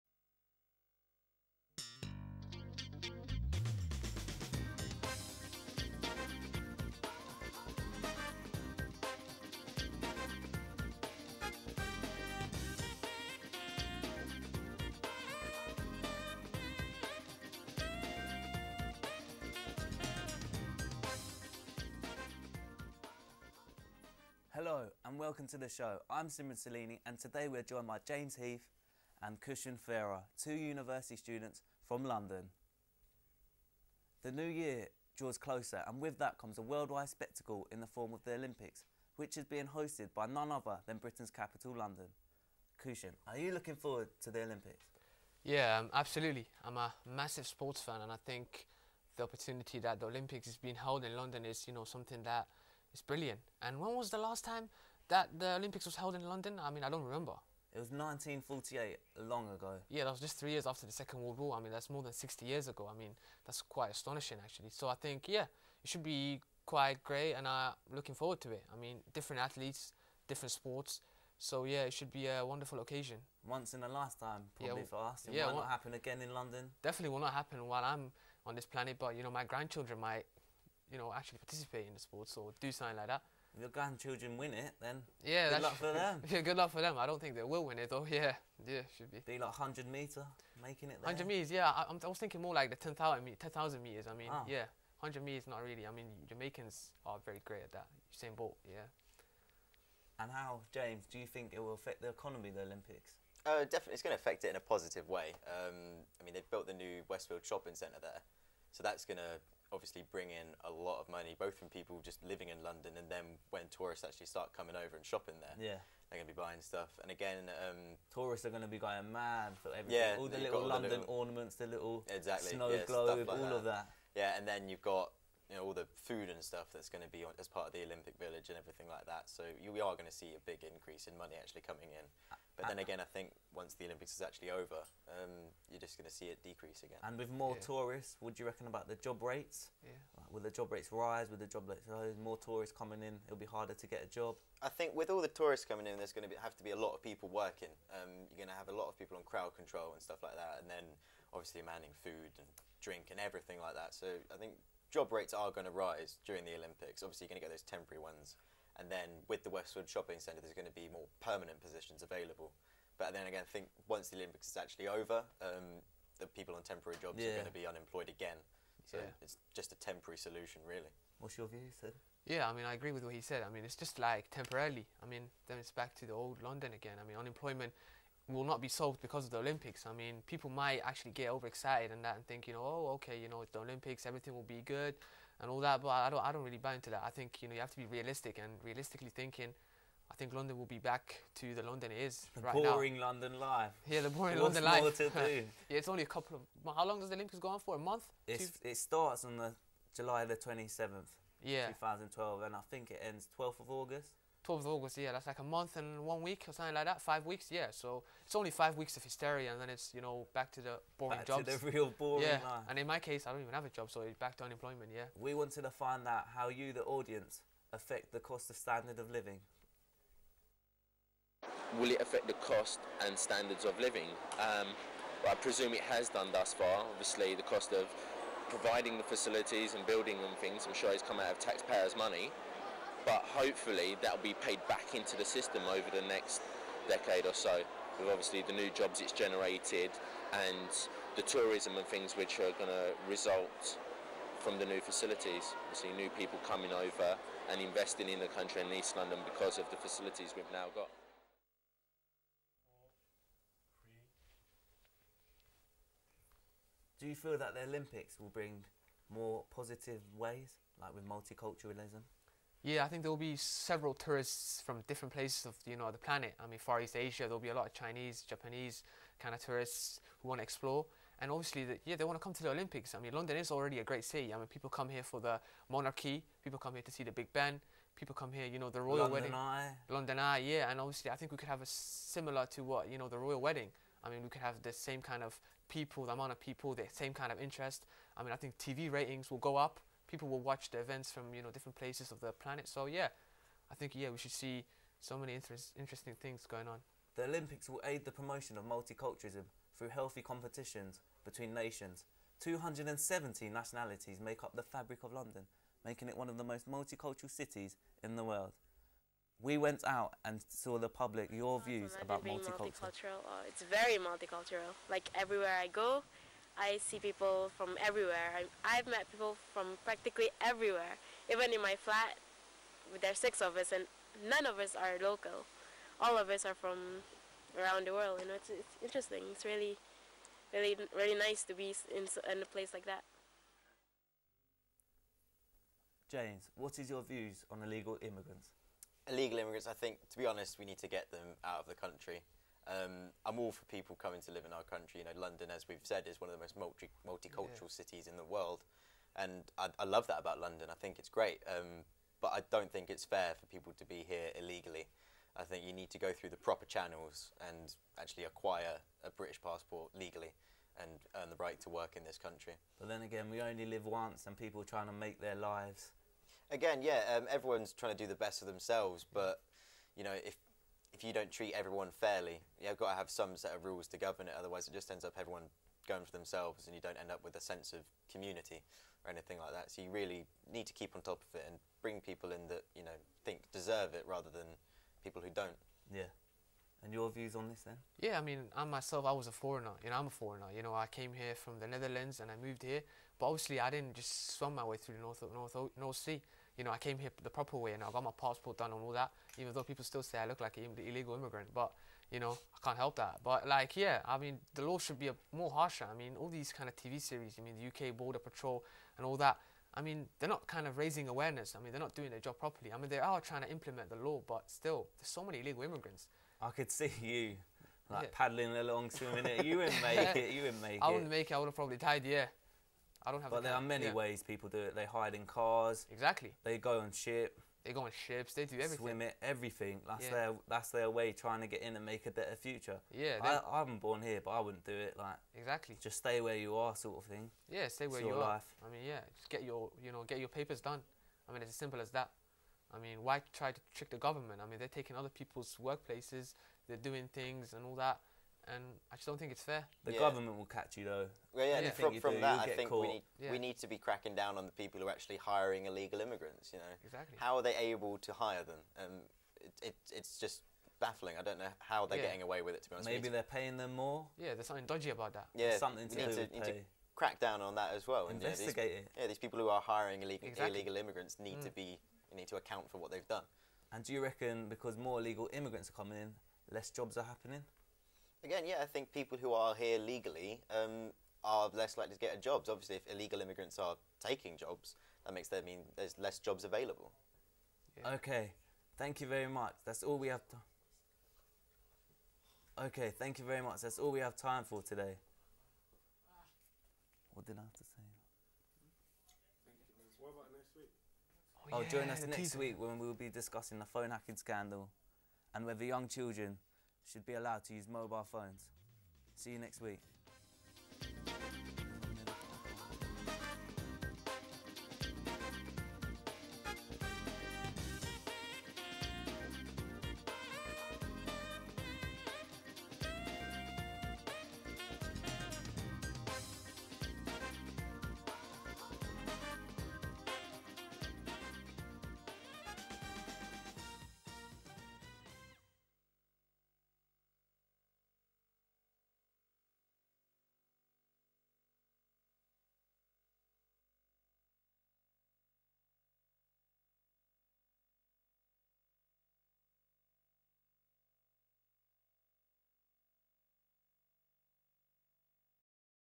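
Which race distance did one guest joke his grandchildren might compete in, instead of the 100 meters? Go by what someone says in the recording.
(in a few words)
10,000 meters.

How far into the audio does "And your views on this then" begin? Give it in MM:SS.
06:26.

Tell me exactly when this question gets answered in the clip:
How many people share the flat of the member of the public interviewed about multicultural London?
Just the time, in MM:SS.
05:23.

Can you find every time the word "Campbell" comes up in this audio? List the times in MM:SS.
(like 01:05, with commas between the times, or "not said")
not said.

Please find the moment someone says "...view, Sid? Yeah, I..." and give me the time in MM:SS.
02:51.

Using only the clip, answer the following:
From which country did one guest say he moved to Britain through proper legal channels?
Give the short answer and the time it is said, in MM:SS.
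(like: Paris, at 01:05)
The Netherlands, at 06:31.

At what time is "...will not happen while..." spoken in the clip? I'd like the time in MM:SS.
01:17.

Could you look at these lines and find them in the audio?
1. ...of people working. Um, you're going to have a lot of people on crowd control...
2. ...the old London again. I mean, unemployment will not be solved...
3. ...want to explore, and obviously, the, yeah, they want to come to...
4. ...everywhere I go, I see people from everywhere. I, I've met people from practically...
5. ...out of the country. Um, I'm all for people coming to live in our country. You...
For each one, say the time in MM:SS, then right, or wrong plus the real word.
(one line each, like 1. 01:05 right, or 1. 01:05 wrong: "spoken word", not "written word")
1. 02:26 right
2. 02:56 right
3. 04:30 right
4. 05:15 right
5. 05:41 right.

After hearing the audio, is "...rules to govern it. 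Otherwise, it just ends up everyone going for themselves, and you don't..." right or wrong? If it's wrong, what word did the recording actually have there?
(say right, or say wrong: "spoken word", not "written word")
right.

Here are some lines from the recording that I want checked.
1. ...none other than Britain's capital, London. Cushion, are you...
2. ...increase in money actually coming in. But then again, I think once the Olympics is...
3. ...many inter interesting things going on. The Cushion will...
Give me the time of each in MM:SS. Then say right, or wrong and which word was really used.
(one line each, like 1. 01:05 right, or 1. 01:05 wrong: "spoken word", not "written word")
1. 00:40 right
2. 02:10 right
3. 04:55 wrong: "Olympics", not "Cushion".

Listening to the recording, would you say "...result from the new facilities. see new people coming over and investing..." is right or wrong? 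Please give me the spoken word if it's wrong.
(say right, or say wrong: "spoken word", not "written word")
right.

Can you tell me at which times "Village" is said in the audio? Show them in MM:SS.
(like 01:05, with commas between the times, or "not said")
02:08.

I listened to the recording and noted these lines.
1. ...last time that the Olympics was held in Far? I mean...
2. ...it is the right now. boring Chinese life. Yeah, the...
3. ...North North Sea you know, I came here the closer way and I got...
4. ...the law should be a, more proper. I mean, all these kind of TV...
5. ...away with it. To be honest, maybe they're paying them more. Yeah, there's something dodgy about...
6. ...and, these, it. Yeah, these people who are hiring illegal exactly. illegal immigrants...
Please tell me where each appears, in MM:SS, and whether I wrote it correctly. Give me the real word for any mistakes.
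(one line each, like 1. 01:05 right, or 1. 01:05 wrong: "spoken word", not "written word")
1. 00:54 wrong: "London", not "Far"
2. 03:11 wrong: "London", not "Chinese"
3. 06:35 wrong: "proper", not "closer"
4. 06:44 wrong: "harsher", not "proper"
5. 07:42 right
6. 07:48 right.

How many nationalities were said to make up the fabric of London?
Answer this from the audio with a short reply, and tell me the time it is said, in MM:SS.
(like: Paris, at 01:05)
270, at 05:02.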